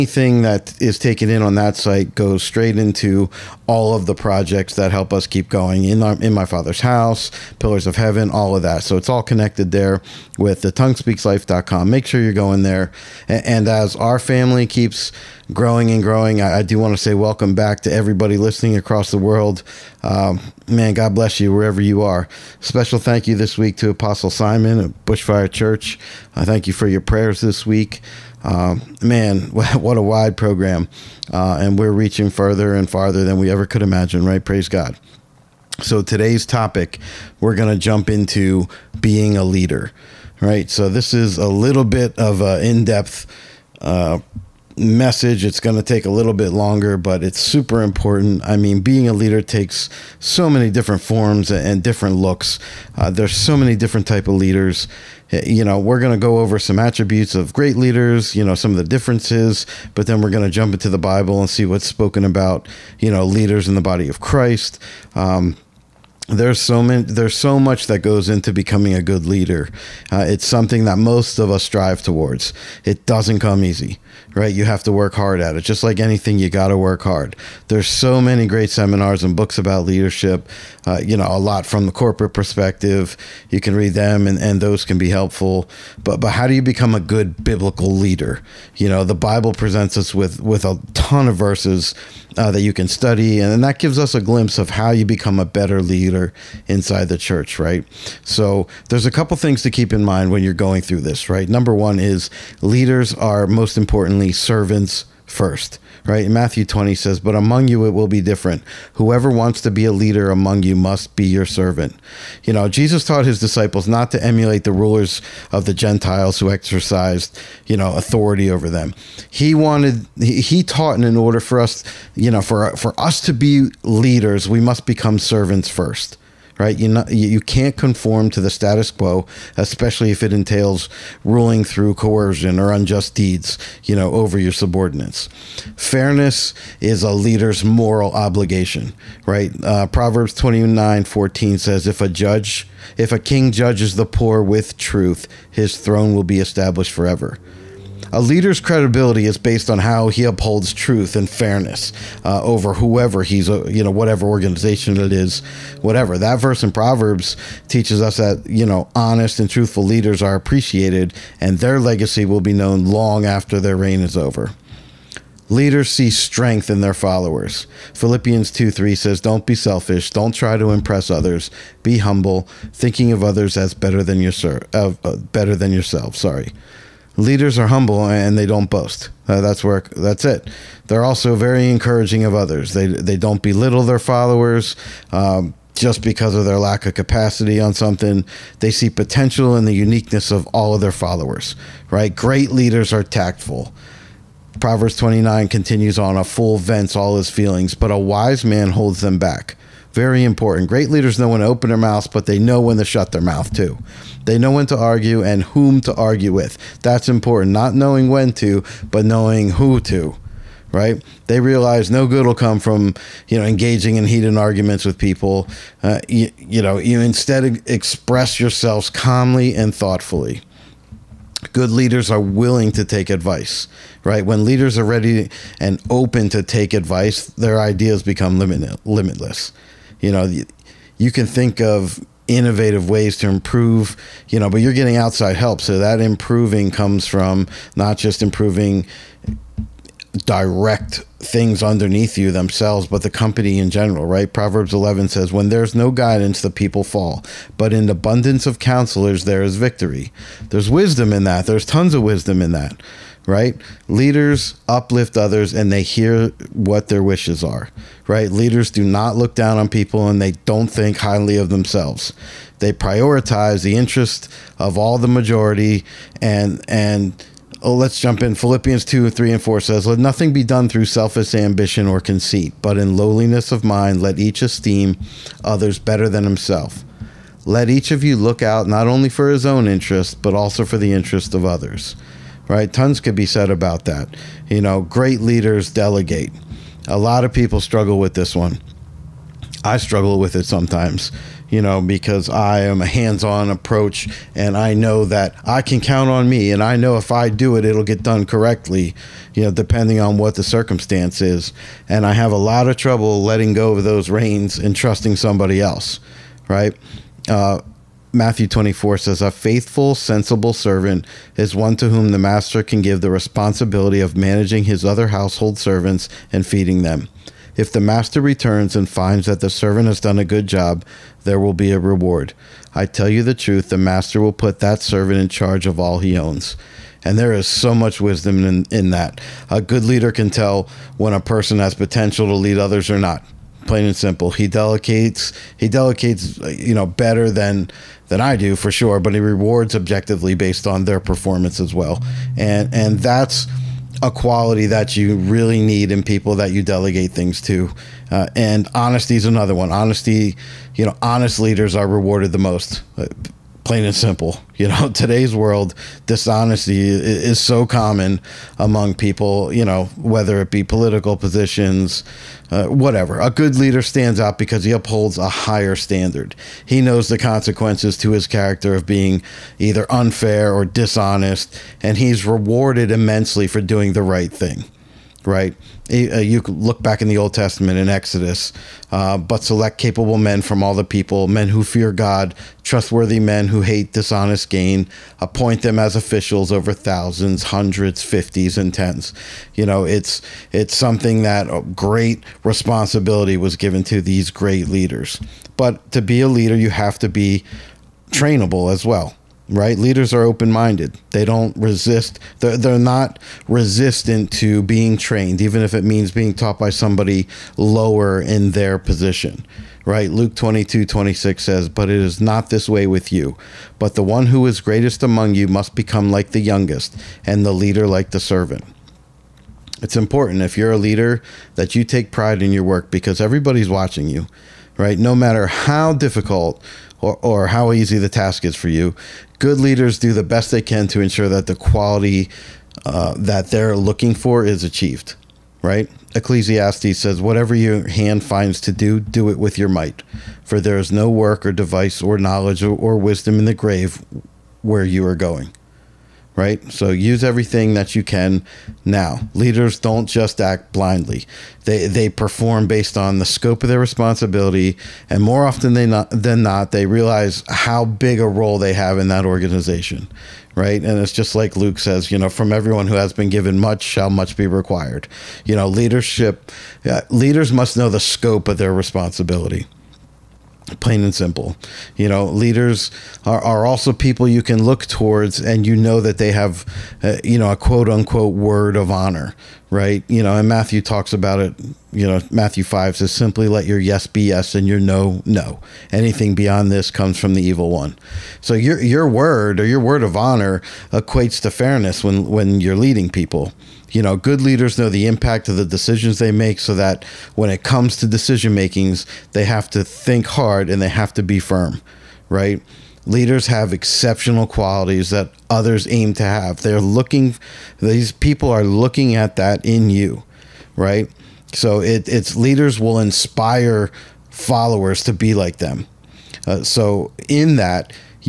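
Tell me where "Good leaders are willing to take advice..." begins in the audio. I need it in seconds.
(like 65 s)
221 s.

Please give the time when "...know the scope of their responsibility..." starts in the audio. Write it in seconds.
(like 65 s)
467 s.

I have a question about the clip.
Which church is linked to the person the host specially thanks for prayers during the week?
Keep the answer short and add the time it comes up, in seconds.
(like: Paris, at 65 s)
Bushfire Church, at 25 s.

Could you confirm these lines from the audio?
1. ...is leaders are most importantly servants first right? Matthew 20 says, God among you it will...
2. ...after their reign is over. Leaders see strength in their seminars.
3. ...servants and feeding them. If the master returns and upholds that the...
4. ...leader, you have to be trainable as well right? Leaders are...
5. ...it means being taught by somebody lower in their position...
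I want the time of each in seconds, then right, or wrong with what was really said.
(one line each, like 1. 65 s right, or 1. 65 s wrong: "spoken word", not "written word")
1. 101 s wrong: "But", not "God"
2. 163 s wrong: "followers", not "seminars"
3. 315 s wrong: "finds", not "upholds"
4. 396 s right
5. 405 s right.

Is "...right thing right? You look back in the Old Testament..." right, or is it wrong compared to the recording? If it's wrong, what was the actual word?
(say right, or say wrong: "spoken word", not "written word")
right.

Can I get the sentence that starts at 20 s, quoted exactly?
Um, man, God bless you wherever you are.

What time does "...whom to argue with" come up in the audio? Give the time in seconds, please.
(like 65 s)
205 s.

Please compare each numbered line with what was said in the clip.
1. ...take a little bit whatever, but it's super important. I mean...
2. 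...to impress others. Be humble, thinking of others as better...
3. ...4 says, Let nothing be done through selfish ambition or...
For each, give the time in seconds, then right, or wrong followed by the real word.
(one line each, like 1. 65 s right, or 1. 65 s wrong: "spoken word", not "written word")
1. 45 s wrong: "longer", not "whatever"
2. 170 s right
3. 269 s right.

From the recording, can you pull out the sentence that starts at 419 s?
It's important if you're a leader that you take pride in your work because everybody's watching you, right?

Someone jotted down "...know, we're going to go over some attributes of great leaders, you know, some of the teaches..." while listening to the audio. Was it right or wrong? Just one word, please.
wrong.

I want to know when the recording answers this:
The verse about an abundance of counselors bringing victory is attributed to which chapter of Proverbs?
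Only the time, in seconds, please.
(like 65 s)
244 s.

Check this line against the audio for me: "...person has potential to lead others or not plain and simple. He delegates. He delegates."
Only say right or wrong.
right.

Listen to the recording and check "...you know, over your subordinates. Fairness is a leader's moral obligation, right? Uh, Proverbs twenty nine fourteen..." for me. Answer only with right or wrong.
right.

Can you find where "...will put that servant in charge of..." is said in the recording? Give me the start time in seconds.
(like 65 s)
324 s.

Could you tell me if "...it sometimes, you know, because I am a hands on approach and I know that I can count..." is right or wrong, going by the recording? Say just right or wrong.
right.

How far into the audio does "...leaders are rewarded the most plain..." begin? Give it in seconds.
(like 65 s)
351 s.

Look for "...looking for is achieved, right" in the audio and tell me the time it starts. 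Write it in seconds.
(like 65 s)
433 s.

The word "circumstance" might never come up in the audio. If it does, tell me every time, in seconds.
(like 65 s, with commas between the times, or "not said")
300 s.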